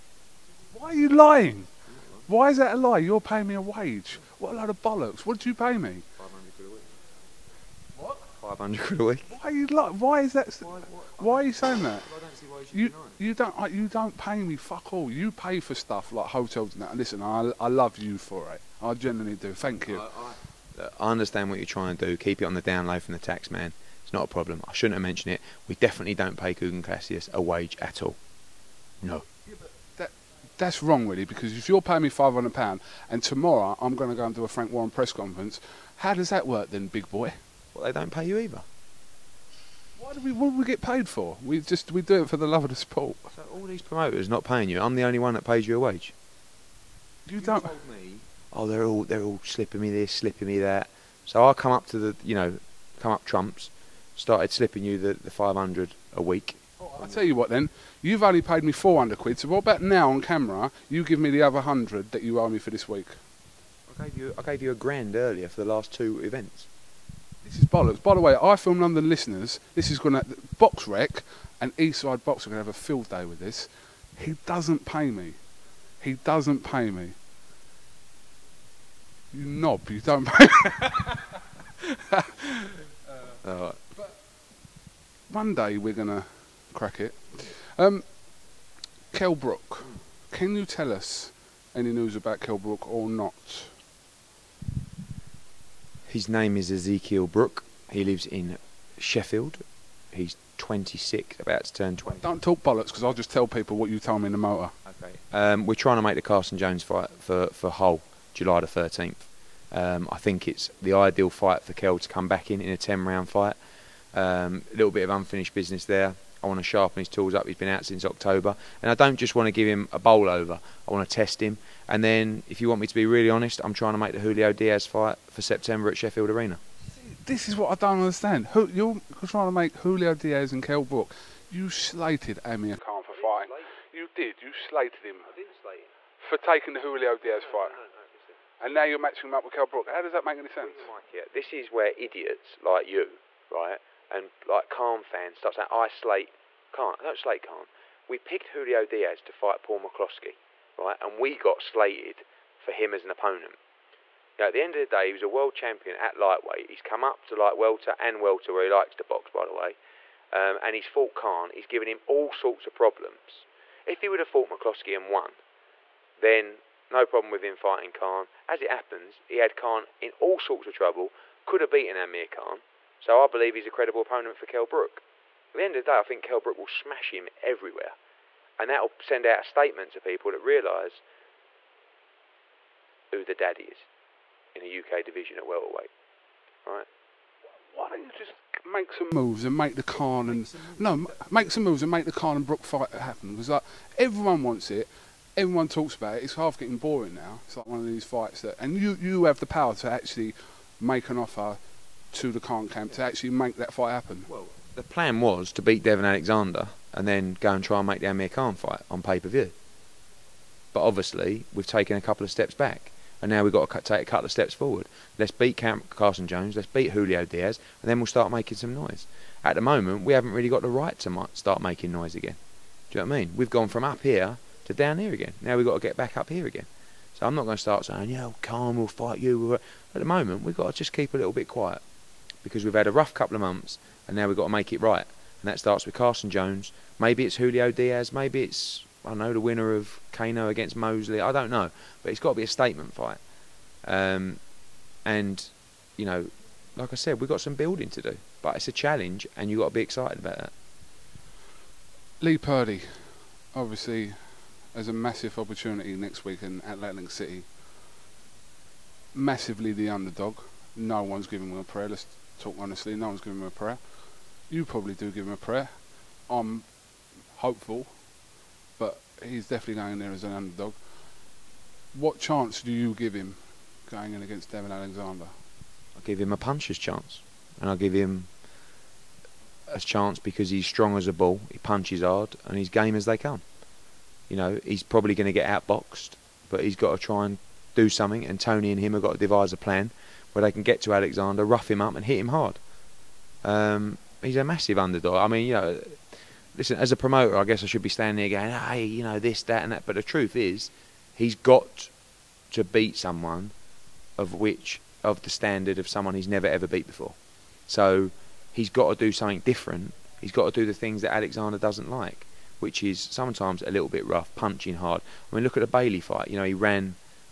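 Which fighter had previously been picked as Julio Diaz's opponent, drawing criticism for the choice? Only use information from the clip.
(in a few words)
Paul McCloskey.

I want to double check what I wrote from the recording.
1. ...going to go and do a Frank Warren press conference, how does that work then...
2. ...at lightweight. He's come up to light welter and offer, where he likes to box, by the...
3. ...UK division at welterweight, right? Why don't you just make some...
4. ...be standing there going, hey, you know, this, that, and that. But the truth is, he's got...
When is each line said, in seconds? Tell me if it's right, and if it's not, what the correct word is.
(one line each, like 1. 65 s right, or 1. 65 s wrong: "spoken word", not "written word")
1. 33 s right
2. 155 s wrong: "welter", not "offer"
3. 184 s right
4. 297 s right.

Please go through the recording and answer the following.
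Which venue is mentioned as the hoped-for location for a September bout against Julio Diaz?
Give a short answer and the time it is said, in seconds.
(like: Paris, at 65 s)
Sheffield Arena, at 125 s.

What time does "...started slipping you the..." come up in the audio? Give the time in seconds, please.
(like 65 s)
54 s.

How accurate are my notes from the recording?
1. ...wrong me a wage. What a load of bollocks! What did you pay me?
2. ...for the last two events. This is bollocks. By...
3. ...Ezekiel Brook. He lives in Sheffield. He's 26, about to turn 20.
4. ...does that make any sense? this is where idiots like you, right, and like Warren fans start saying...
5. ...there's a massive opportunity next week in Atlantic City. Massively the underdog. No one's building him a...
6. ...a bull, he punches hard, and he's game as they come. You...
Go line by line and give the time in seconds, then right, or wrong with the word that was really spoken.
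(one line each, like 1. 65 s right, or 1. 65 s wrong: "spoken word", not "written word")
1. 3 s wrong: "paying", not "wrong"
2. 65 s right
3. 96 s right
4. 140 s wrong: "Khan", not "Warren"
5. 254 s wrong: "giving", not "building"
6. 281 s right.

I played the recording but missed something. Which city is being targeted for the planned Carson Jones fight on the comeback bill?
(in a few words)
Hull.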